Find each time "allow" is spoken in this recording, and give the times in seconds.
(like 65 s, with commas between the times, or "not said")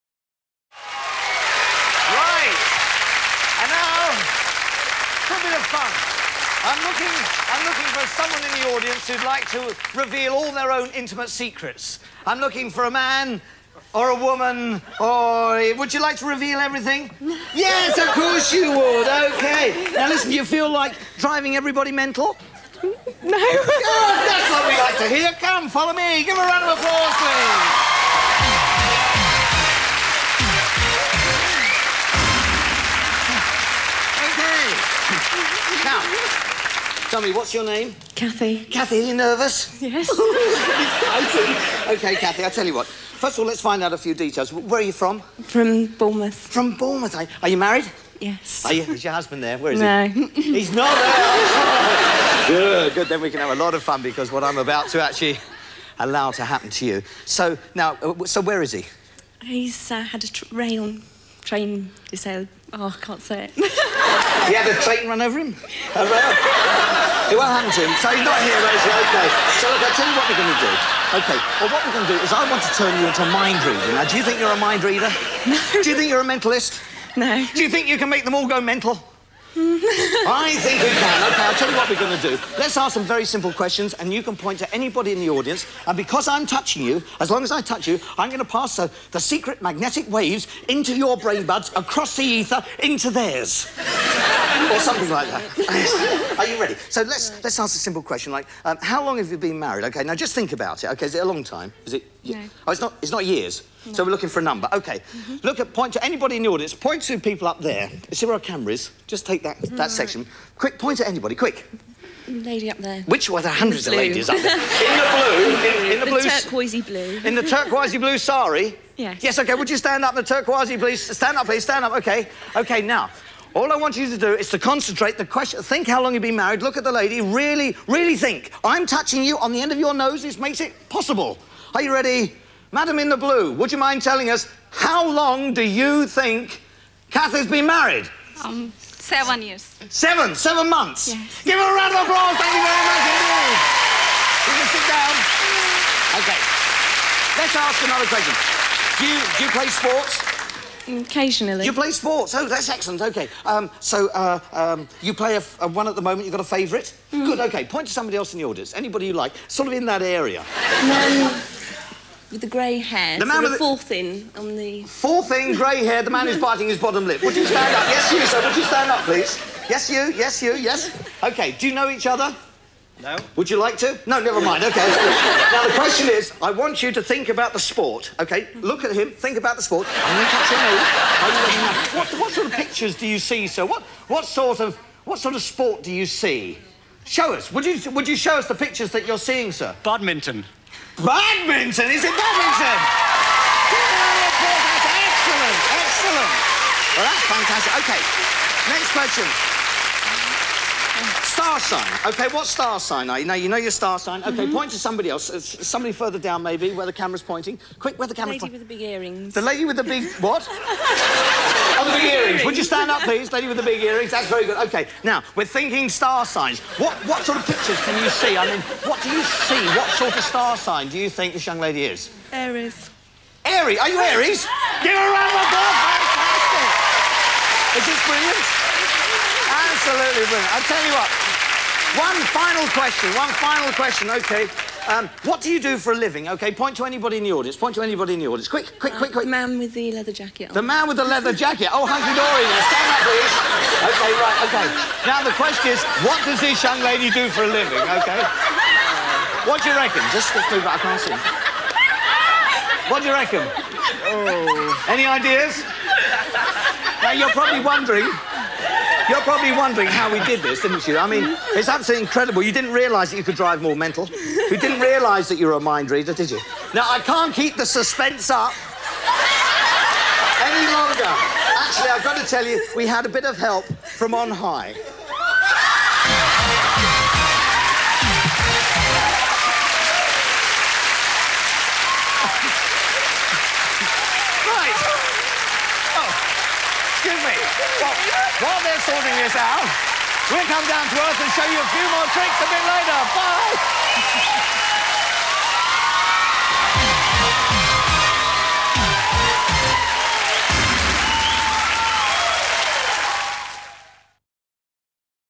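55 s.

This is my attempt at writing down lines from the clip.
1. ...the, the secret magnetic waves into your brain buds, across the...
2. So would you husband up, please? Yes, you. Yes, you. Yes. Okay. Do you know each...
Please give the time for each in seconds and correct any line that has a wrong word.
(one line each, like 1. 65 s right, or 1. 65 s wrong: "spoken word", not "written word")
1. 88 s right
2. 168 s wrong: "stand", not "husband".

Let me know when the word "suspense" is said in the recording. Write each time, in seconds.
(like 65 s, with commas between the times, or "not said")
267 s.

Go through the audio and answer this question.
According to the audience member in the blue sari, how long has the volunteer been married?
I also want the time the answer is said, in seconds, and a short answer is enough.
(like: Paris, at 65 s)
7 months, at 140 s.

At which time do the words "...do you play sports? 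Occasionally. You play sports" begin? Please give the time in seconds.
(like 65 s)
149 s.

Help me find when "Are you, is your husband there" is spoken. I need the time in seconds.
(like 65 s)
48 s.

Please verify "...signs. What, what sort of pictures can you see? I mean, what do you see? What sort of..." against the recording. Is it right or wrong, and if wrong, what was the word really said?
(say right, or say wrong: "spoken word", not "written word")
right.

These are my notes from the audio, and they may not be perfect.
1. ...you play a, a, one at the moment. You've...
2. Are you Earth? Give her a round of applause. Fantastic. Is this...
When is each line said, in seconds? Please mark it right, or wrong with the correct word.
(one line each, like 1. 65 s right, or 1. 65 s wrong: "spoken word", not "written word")
1. 155 s right
2. 223 s wrong: "Aries", not "Earth".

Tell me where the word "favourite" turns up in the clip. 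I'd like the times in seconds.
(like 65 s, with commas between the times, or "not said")
156 s.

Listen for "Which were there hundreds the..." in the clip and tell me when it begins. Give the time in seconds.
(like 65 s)
113 s.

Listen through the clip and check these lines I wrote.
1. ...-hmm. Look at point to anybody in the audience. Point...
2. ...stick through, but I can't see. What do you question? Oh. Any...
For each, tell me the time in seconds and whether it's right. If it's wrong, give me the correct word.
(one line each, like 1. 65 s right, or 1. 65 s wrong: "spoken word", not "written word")
1. 105 s right
2. 250 s wrong: "reckon", not "question".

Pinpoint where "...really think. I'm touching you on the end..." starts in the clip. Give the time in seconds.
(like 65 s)
127 s.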